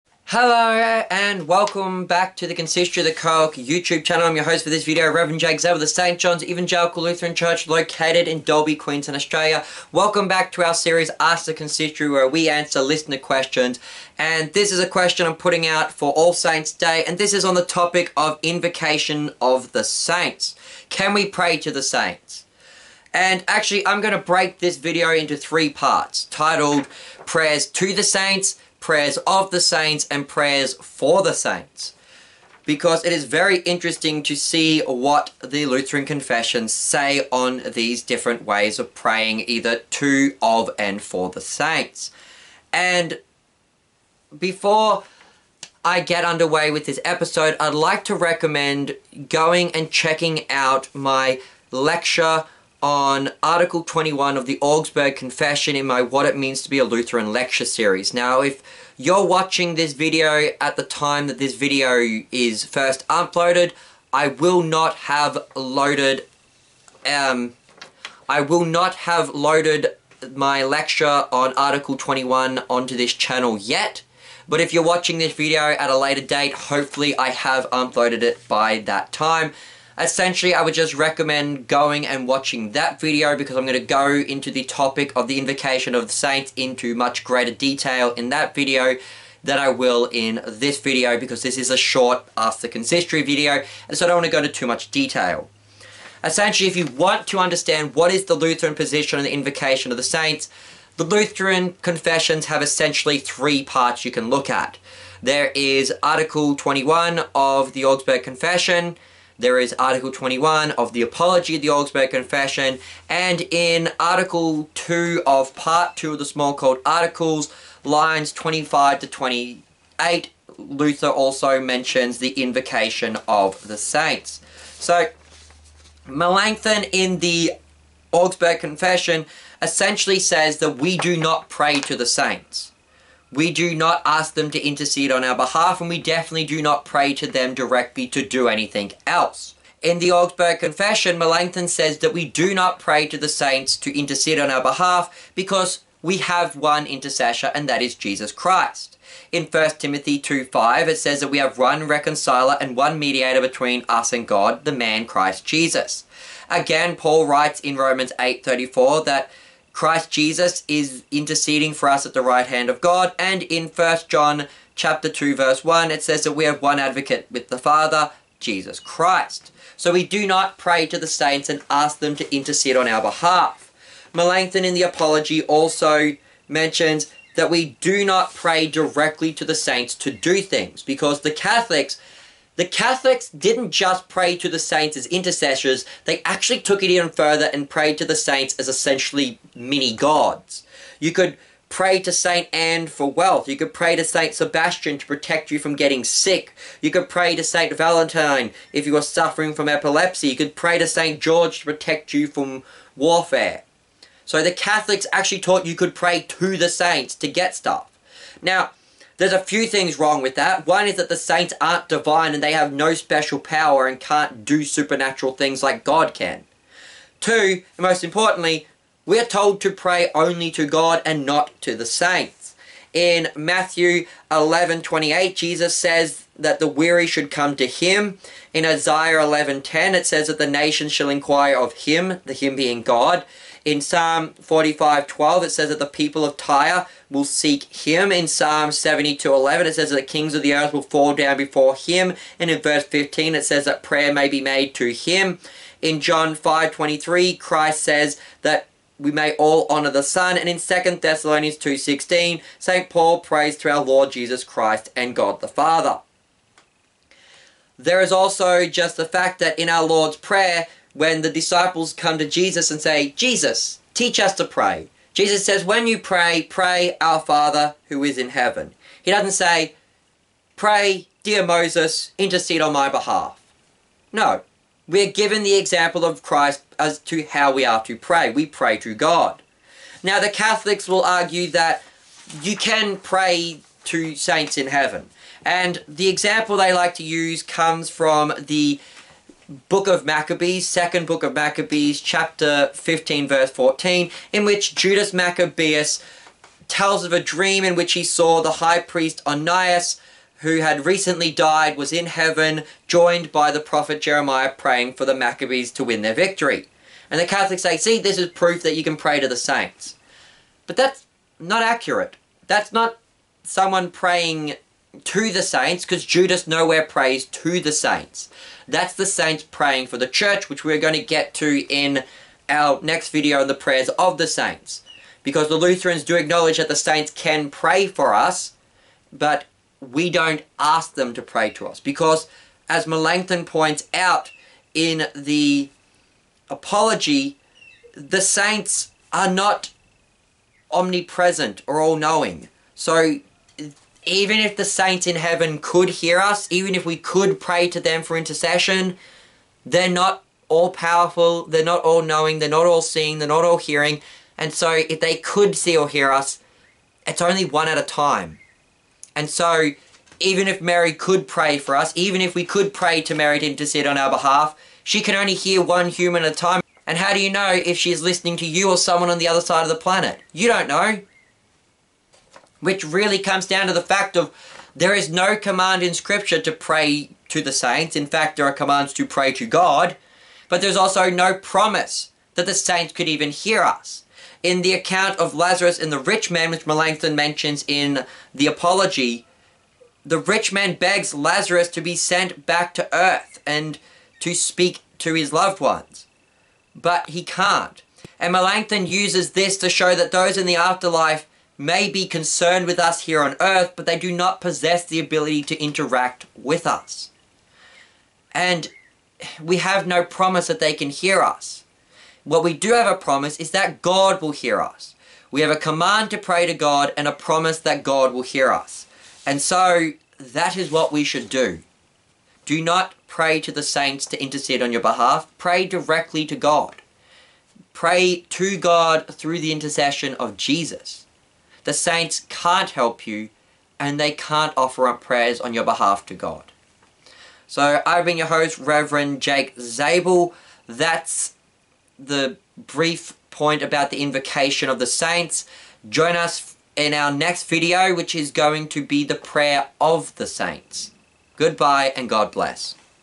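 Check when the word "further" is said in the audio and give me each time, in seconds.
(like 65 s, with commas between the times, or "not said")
187 s.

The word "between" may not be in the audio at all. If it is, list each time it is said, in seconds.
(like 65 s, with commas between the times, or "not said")
153 s.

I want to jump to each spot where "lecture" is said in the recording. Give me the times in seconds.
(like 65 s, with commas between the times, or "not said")
51 s, 57 s, 70 s.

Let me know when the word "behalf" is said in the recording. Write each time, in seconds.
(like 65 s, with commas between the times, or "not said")
135 s, 144 s, 173 s, 272 s, 364 s, 424 s, 435 s.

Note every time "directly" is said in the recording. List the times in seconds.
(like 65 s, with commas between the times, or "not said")
137 s, 178 s, 425 s.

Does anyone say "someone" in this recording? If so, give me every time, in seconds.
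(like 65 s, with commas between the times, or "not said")
313 s, 368 s.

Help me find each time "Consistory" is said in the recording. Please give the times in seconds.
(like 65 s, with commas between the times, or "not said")
2 s, 11 s, 92 s.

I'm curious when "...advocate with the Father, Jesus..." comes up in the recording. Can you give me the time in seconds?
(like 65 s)
166 s.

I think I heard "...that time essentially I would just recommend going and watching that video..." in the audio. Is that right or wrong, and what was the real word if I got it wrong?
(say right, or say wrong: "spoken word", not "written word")
right.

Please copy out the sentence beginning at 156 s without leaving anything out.
Again, Paul writes in Romans eight thirty four that Christ Jesus is interceding for us at the right hand of God.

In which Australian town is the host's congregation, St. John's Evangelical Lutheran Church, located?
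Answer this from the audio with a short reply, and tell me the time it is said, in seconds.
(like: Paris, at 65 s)
Dalby, at 8 s.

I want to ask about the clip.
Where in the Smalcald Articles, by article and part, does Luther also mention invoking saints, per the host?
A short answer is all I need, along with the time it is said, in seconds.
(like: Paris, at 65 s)
Article 2 of Part 2, at 113 s.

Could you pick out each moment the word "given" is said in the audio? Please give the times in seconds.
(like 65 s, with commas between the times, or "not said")
275 s.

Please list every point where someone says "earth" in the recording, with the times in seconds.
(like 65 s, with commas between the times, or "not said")
240 s, 392 s, 403 s.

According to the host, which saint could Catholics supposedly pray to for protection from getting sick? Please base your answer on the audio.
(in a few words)
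Saint Sebastian.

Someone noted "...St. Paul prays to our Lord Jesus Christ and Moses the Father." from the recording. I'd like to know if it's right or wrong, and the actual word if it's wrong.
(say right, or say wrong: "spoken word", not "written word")
wrong: "God", not "Moses".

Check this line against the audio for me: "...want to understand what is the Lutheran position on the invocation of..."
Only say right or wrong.
right.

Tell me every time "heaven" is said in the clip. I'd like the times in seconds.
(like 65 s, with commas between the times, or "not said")
268 s, 284 s, 302 s, 345 s.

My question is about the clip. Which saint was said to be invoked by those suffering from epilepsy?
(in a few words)
Saint Valentine.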